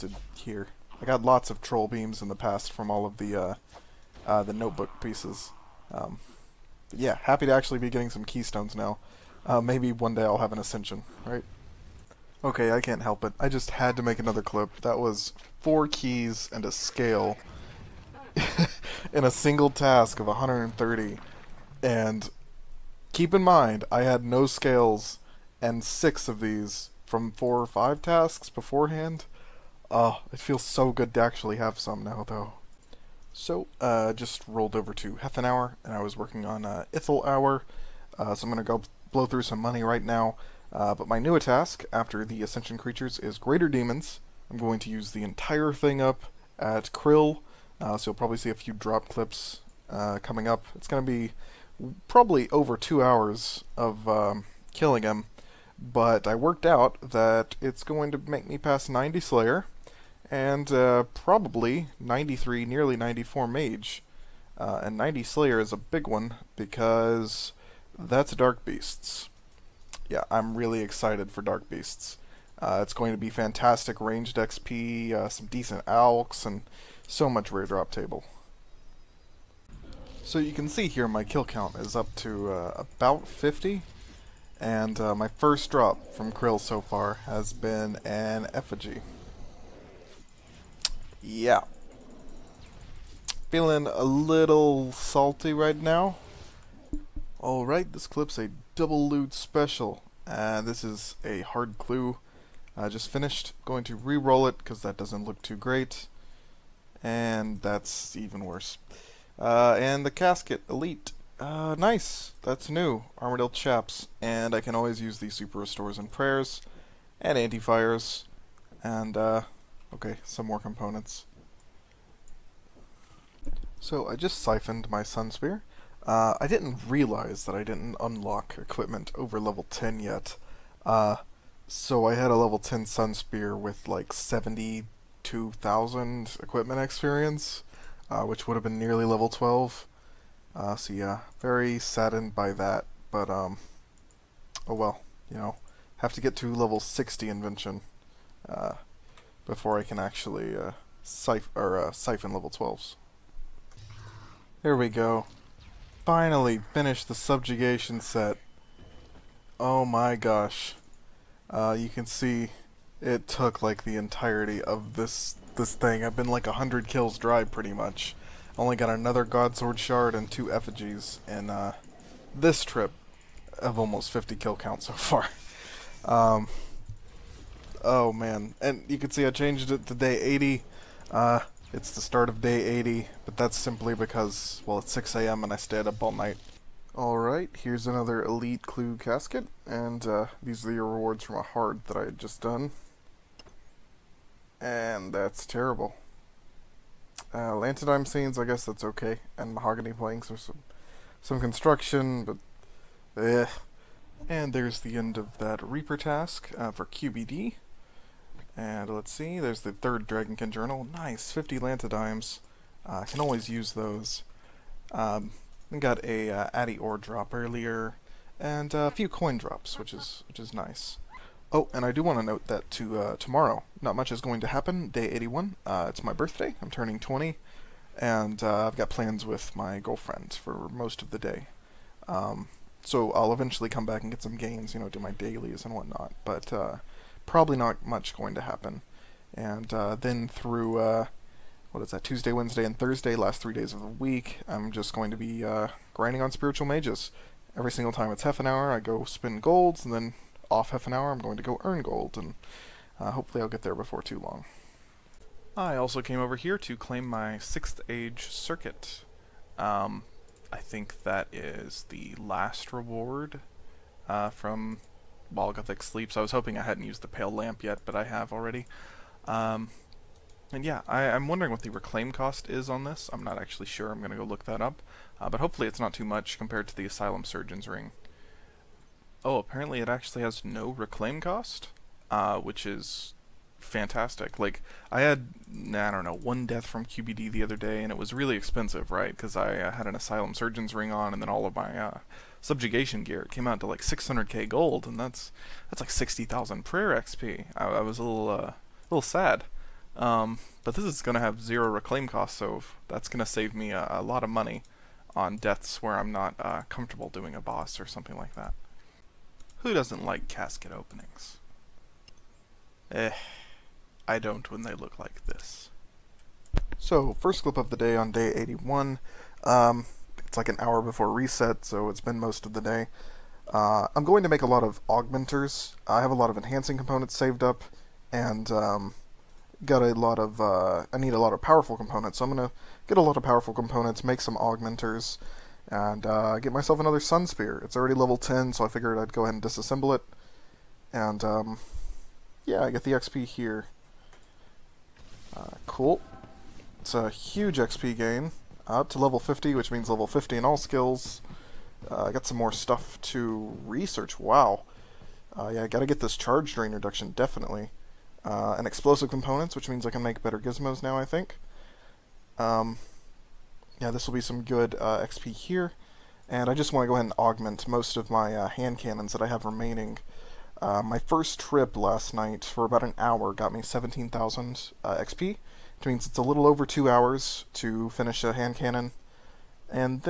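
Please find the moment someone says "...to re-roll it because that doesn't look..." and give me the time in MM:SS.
01:43.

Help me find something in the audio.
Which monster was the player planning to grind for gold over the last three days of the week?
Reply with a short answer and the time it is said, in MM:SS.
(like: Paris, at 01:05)
spiritual mages, at 04:06.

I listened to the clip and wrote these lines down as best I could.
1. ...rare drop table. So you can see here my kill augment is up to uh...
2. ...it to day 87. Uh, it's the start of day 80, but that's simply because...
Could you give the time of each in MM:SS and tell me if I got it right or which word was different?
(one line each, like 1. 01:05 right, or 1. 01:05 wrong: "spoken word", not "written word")
1. 01:17 wrong: "count", not "augment"
2. 02:59 wrong: "80", not "87".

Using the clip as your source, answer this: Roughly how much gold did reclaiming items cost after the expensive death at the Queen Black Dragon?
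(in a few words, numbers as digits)
600k.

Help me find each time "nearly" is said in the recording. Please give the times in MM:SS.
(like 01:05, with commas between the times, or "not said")
01:02, 02:18.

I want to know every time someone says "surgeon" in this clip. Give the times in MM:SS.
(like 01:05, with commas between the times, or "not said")
04:37, 04:50.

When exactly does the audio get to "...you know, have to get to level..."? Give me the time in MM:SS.
02:25.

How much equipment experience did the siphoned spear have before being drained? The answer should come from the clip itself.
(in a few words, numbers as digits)
72,000.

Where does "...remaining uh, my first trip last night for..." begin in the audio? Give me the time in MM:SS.
06:09.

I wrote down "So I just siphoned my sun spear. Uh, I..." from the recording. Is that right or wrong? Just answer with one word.
right.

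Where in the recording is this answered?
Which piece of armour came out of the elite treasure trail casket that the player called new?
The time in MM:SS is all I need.
01:53.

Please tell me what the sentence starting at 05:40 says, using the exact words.
And, um, yeah, I get the XP here.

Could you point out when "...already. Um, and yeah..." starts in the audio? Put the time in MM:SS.
04:28.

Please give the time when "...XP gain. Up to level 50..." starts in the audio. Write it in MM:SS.
05:47.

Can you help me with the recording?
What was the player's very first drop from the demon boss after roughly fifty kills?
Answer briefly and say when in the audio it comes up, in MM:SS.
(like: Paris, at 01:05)
effigy, at 01:28.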